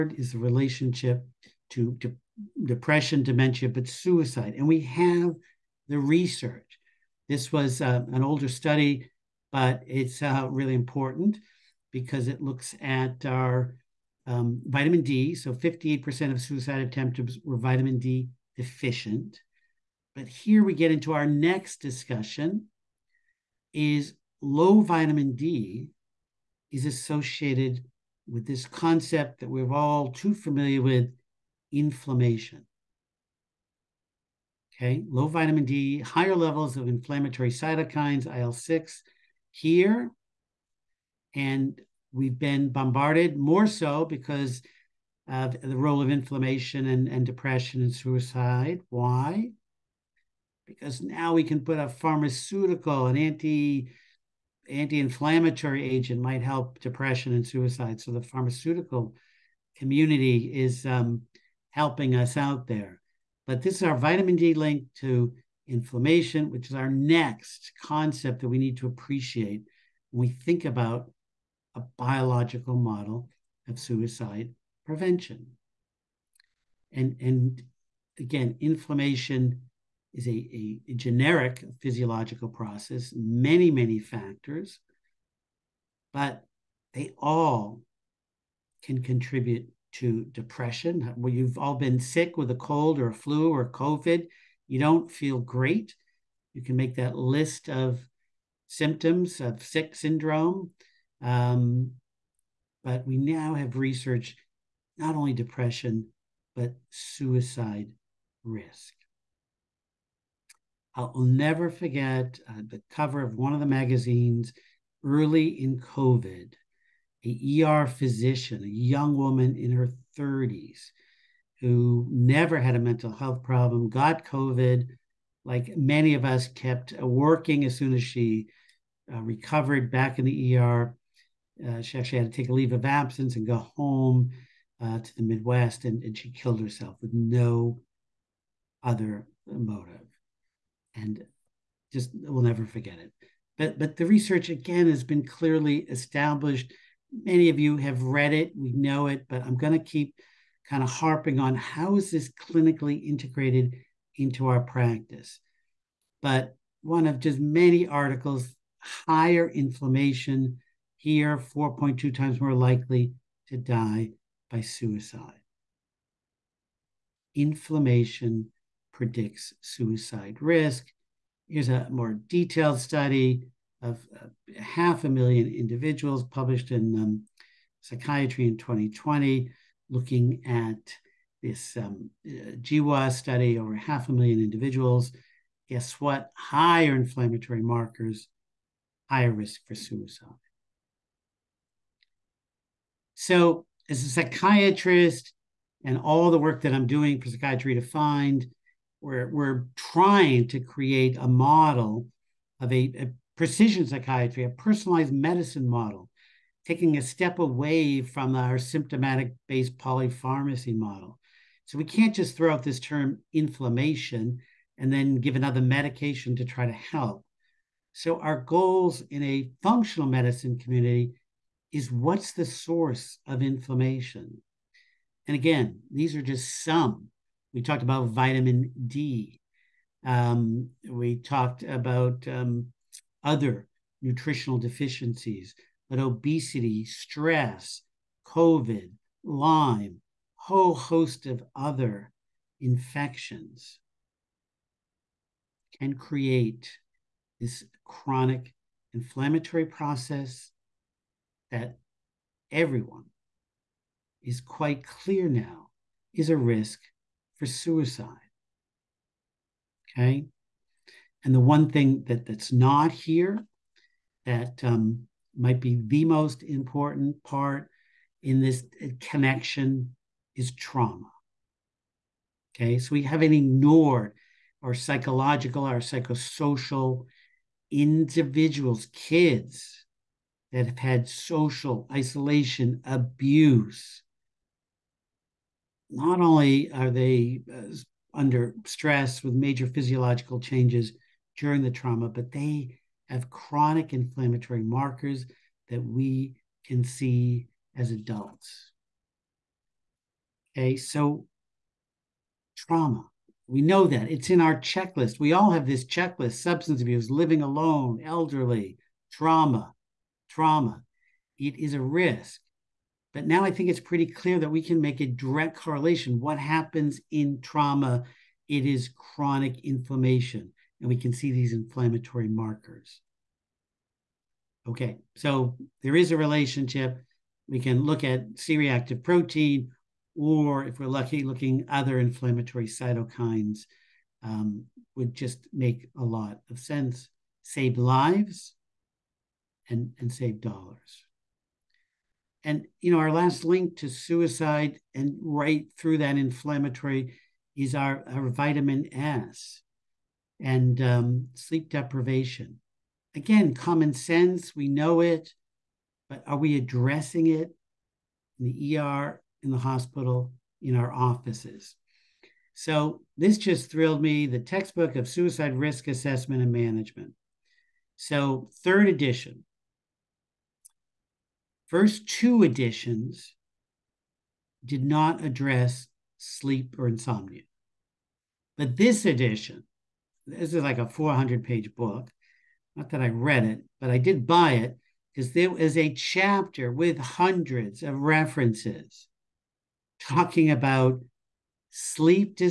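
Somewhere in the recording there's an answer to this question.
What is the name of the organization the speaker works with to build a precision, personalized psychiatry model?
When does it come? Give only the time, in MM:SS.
03:17.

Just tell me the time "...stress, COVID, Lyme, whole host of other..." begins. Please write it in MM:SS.
03:56.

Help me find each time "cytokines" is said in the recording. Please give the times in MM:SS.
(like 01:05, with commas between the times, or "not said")
00:37, 05:32.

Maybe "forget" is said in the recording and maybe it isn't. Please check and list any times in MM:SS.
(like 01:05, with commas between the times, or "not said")
01:51, 02:22.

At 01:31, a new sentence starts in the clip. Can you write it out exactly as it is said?
Well, you've all been sick with a cold or a flu or COVID.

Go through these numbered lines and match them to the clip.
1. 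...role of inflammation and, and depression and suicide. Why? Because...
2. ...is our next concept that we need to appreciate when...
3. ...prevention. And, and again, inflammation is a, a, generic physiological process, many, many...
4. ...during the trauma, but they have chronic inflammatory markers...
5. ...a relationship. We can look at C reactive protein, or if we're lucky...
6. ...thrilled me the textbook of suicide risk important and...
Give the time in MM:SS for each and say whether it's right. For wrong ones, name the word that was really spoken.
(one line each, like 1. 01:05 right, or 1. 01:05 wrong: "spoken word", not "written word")
1. 00:45 right
2. 01:06 right
3. 01:14 right
4. 04:51 right
5. 05:26 right
6. 06:03 wrong: "assessment", not "important".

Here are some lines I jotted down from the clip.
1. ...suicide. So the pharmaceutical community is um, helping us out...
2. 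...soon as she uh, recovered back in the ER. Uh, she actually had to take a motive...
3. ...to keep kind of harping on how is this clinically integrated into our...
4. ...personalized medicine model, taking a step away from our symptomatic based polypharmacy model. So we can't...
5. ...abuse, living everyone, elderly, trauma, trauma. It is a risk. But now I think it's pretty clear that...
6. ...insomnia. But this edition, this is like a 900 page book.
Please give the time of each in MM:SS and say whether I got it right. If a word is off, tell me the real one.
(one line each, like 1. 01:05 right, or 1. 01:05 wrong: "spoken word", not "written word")
1. 00:57 right
2. 02:07 wrong: "leave", not "motive"
3. 02:29 right
4. 03:24 right
5. 05:06 wrong: "alone", not "everyone"
6. 06:16 wrong: "400", not "900".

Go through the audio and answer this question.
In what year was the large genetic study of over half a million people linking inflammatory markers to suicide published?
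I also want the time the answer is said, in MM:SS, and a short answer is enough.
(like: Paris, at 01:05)
2020, at 02:58.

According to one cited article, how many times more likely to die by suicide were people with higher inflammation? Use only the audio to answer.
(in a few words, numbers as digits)
4.2.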